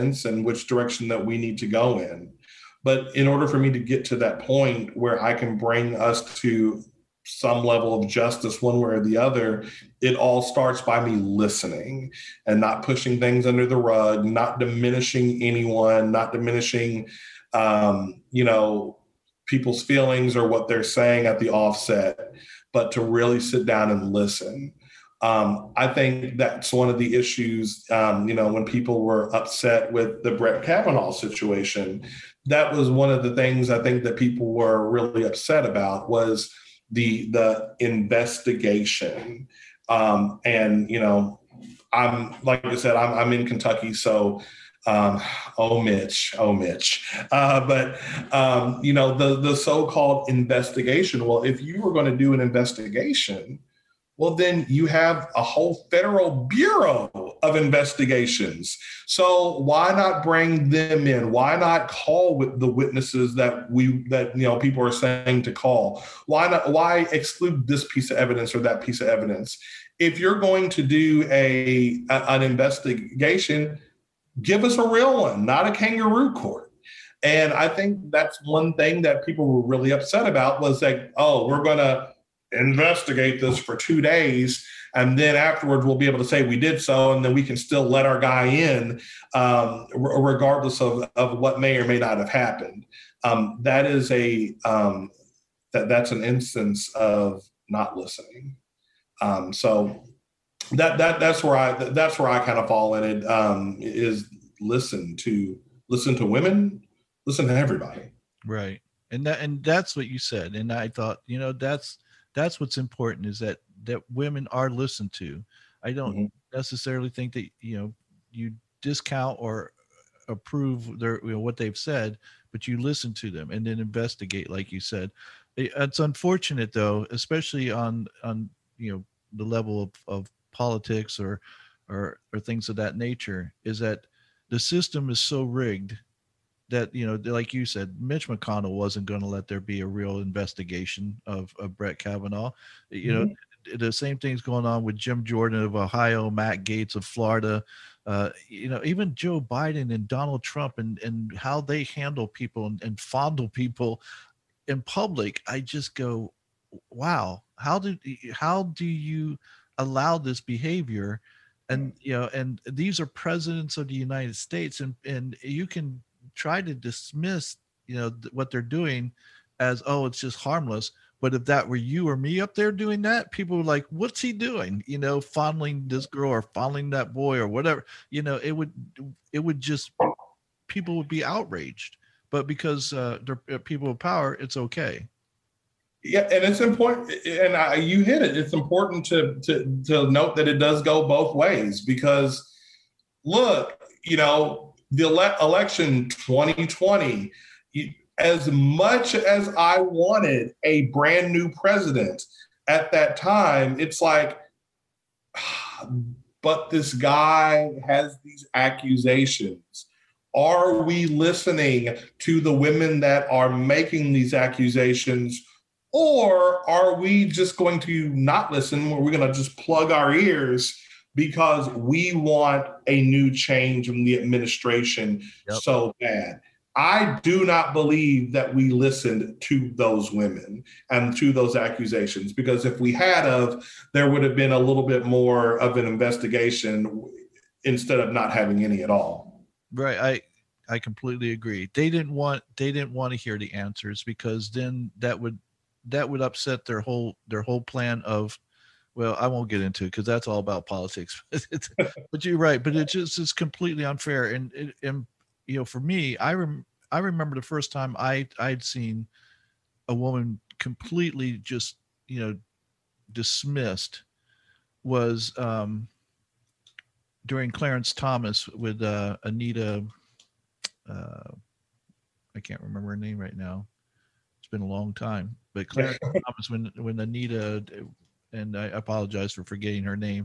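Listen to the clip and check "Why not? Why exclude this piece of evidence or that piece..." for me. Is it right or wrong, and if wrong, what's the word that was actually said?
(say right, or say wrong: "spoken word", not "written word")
right.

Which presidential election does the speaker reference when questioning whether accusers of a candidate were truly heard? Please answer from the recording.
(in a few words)
2020.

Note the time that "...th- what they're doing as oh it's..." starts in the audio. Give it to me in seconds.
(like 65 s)
168 s.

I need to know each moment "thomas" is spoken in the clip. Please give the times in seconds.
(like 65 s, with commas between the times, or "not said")
267 s, 276 s.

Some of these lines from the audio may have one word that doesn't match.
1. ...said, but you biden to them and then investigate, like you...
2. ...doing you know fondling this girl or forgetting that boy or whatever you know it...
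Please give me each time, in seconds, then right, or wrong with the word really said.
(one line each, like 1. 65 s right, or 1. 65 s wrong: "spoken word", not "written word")
1. 121 s wrong: "listen", not "biden"
2. 174 s wrong: "fondling", not "forgetting".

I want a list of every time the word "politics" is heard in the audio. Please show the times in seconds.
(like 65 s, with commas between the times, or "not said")
130 s, 250 s.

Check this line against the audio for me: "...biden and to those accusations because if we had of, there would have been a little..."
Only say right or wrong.
wrong.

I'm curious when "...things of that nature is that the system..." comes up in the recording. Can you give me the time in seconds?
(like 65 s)
132 s.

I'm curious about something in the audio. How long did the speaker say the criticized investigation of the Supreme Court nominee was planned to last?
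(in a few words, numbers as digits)
two days.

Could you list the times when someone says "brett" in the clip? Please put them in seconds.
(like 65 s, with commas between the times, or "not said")
30 s, 141 s.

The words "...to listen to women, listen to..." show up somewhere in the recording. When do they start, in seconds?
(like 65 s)
105 s.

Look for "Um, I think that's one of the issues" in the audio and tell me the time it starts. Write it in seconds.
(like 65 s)
25 s.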